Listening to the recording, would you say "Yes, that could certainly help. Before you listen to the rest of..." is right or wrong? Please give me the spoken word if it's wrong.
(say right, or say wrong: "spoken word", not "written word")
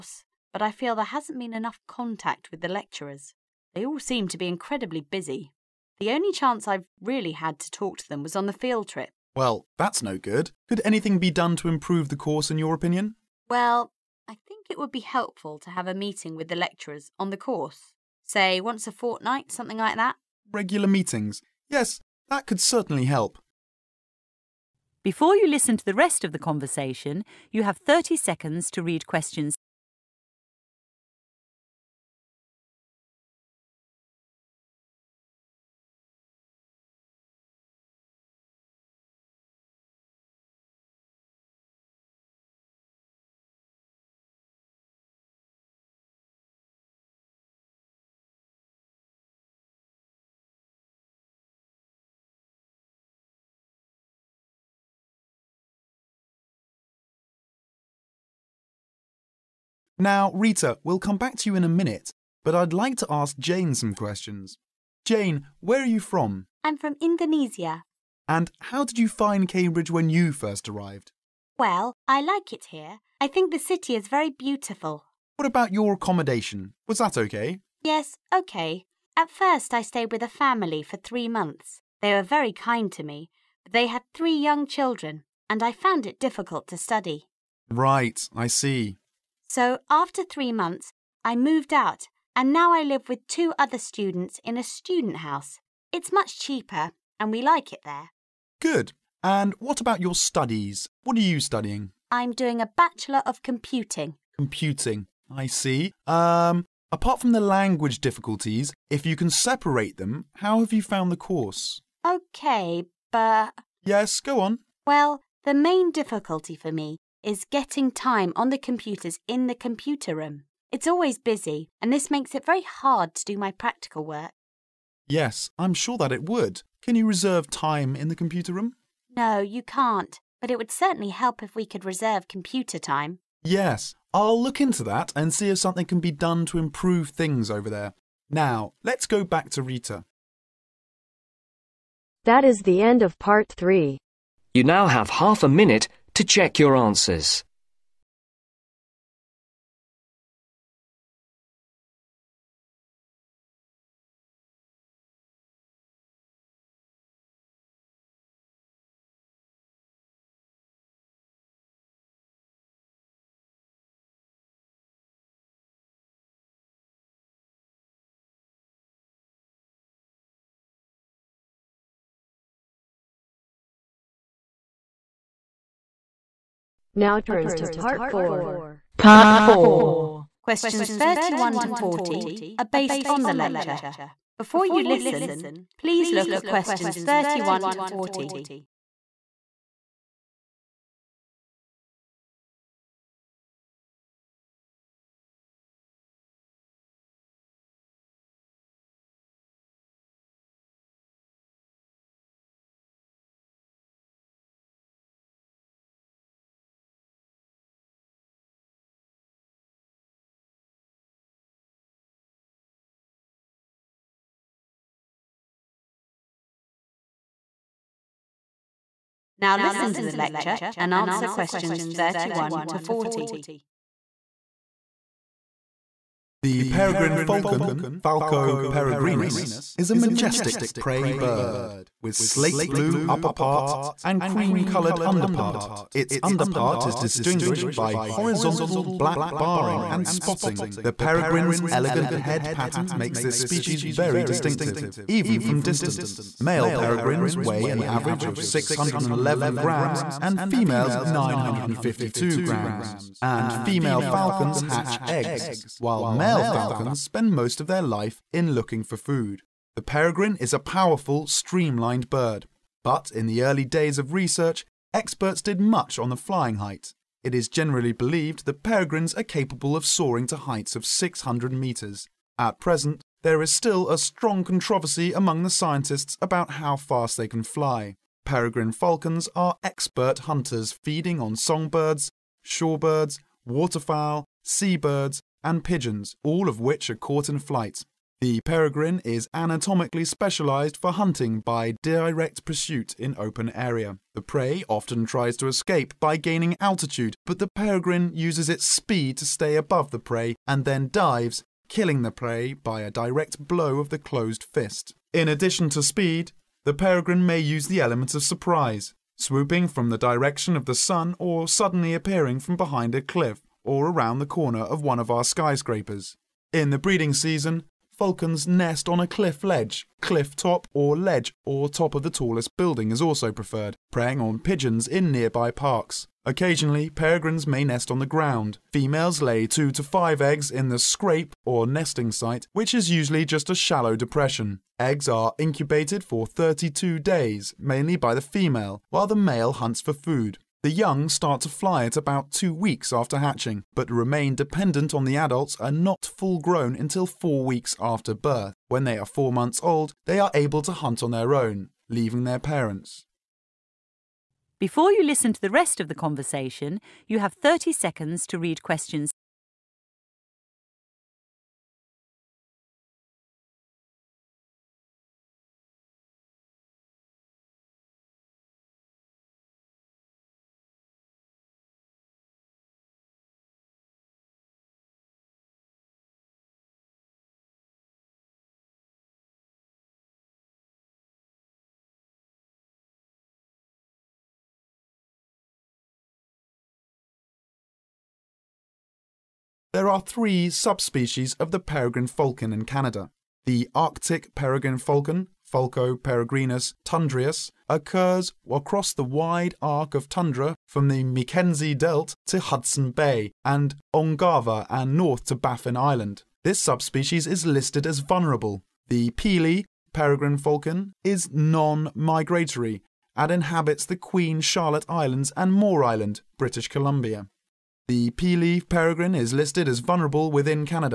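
right.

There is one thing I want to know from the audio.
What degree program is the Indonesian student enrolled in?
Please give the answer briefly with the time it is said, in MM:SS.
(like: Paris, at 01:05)
Bachelor of Computing, at 01:42.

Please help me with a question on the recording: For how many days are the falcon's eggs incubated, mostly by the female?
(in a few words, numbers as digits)
32 days.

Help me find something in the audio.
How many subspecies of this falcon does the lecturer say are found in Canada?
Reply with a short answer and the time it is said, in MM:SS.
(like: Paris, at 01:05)
3, at 06:30.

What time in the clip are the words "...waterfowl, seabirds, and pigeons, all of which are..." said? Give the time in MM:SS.
04:43.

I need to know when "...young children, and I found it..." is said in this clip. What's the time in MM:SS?
01:24.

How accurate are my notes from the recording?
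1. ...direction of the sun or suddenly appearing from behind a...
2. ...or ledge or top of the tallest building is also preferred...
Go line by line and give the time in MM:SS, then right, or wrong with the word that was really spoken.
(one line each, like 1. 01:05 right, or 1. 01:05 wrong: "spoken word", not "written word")
1. 05:09 right
2. 05:20 right.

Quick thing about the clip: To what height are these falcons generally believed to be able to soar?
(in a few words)
600 metres.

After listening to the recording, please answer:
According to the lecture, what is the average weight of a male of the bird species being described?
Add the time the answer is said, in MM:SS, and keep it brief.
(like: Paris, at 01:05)
611 grams, at 04:08.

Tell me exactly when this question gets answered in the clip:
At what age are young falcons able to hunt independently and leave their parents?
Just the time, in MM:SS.
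05:49.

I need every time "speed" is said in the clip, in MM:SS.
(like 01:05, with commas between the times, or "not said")
04:58, 05:05.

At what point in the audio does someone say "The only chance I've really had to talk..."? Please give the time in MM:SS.
00:05.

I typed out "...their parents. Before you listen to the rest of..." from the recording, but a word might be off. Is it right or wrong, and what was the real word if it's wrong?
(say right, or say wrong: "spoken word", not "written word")
right.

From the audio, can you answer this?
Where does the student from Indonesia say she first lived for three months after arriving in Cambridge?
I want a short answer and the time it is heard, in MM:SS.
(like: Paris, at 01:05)
with a family, at 01:19.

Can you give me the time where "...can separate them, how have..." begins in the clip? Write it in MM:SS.
01:49.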